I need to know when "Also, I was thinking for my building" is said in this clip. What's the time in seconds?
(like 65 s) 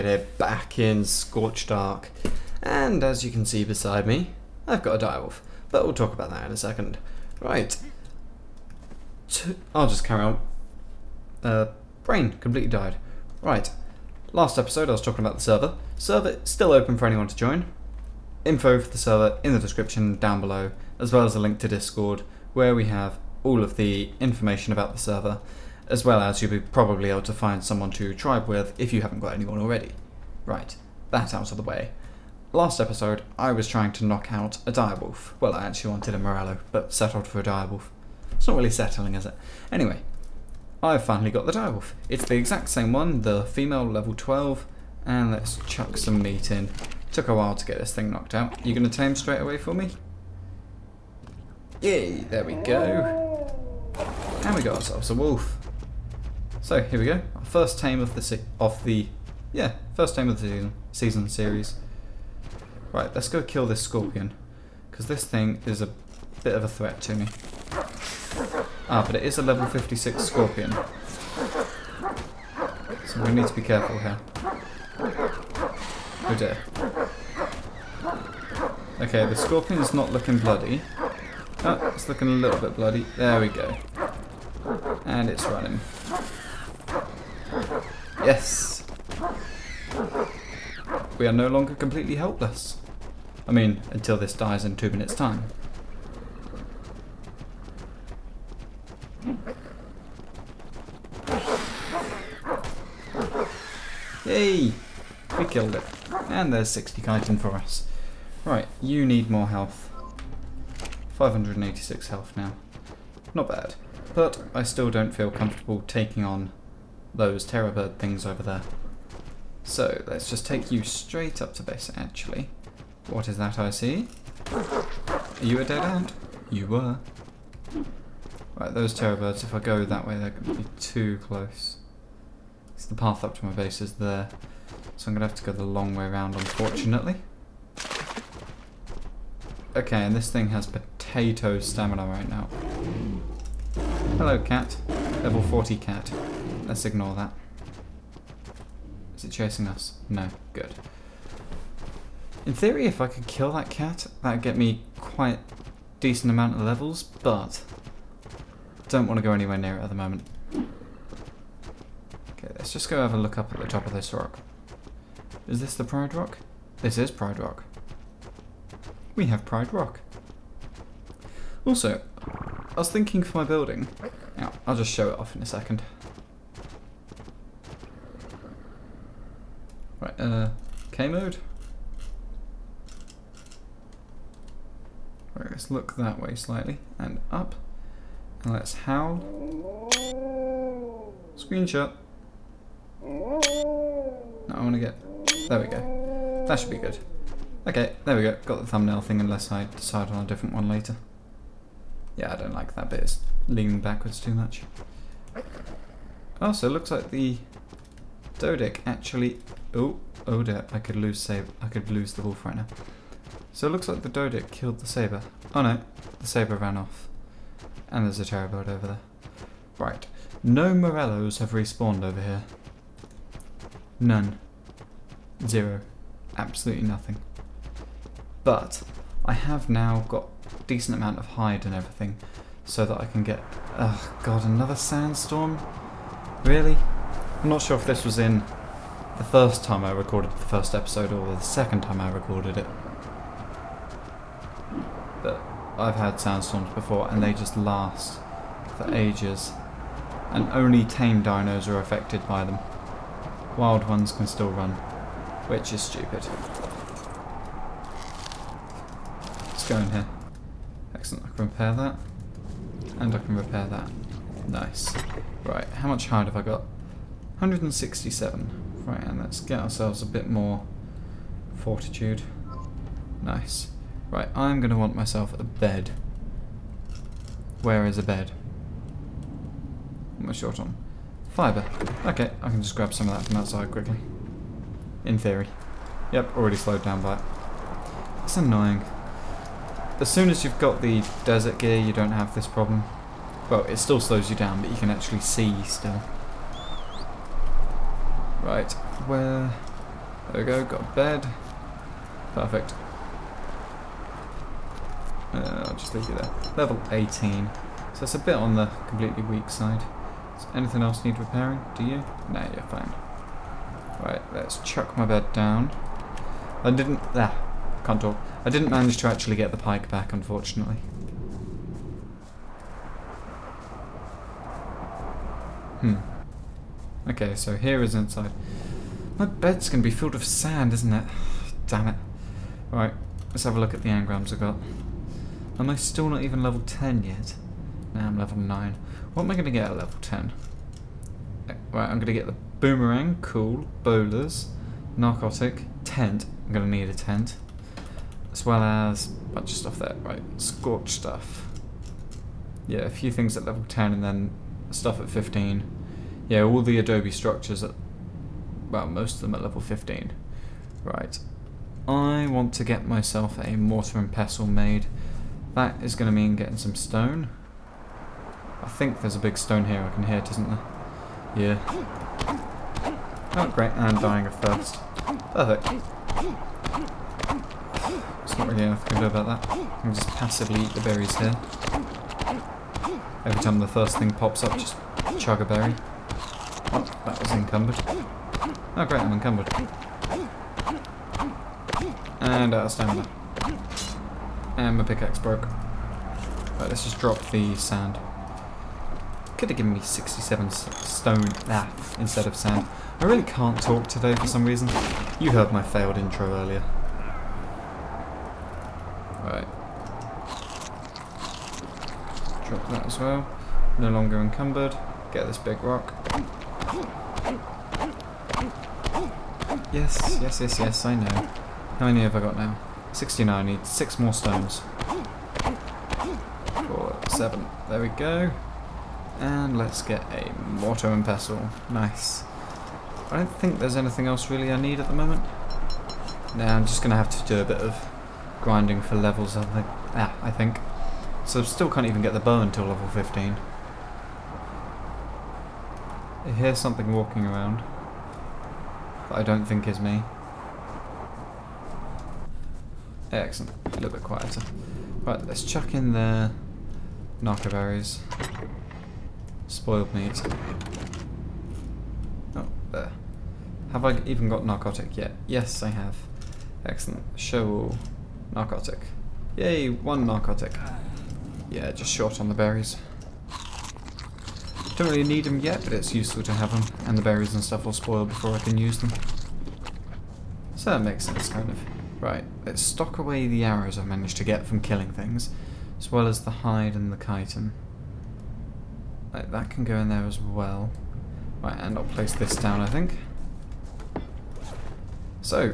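171 s.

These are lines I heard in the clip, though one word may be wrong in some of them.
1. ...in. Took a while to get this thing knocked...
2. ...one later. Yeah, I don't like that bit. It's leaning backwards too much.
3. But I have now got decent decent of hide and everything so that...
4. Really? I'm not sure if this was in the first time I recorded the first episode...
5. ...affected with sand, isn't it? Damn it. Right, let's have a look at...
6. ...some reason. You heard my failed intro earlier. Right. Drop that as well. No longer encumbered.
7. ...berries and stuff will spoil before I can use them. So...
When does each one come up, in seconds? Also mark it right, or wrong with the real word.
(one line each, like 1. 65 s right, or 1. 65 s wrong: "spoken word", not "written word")
1. 46 s right
2. 200 s right
3. 228 s wrong: "amount", not "decent"
4. 236 s right
5. 329 s wrong: "filled", not "affected"
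6. 404 s right
7. 477 s right.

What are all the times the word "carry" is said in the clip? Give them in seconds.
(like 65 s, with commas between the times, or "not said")
10 s.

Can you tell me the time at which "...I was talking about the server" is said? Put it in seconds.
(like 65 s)
14 s.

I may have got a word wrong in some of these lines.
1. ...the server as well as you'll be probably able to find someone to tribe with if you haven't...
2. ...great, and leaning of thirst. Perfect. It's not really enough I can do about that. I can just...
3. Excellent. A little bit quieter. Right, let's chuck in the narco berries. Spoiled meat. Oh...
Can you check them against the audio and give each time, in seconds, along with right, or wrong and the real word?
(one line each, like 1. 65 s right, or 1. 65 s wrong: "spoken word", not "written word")
1. 24 s right
2. 373 s wrong: "dying", not "leaning"
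3. 453 s right.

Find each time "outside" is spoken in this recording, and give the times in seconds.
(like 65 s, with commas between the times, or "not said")
283 s.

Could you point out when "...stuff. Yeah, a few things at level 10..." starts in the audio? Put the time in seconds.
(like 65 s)
350 s.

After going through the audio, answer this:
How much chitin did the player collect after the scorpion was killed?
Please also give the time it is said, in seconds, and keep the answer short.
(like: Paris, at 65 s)
60, at 106 s.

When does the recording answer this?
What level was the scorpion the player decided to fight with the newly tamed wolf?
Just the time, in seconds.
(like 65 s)
69 s.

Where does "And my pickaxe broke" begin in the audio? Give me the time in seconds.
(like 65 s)
394 s.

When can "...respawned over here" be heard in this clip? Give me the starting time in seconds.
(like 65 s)
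221 s.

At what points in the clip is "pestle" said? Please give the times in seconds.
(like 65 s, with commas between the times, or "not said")
364 s, 431 s.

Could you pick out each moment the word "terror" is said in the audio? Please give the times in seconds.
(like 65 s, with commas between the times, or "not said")
117 s, 128 s, 218 s.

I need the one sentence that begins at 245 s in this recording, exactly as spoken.
But I've had sandstorms before and they just last for ages.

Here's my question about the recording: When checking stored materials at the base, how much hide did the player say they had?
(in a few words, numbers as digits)
167.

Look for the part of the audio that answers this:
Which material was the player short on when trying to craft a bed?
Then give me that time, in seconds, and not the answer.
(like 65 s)
281 s.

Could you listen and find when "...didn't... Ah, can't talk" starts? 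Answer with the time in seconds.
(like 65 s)
316 s.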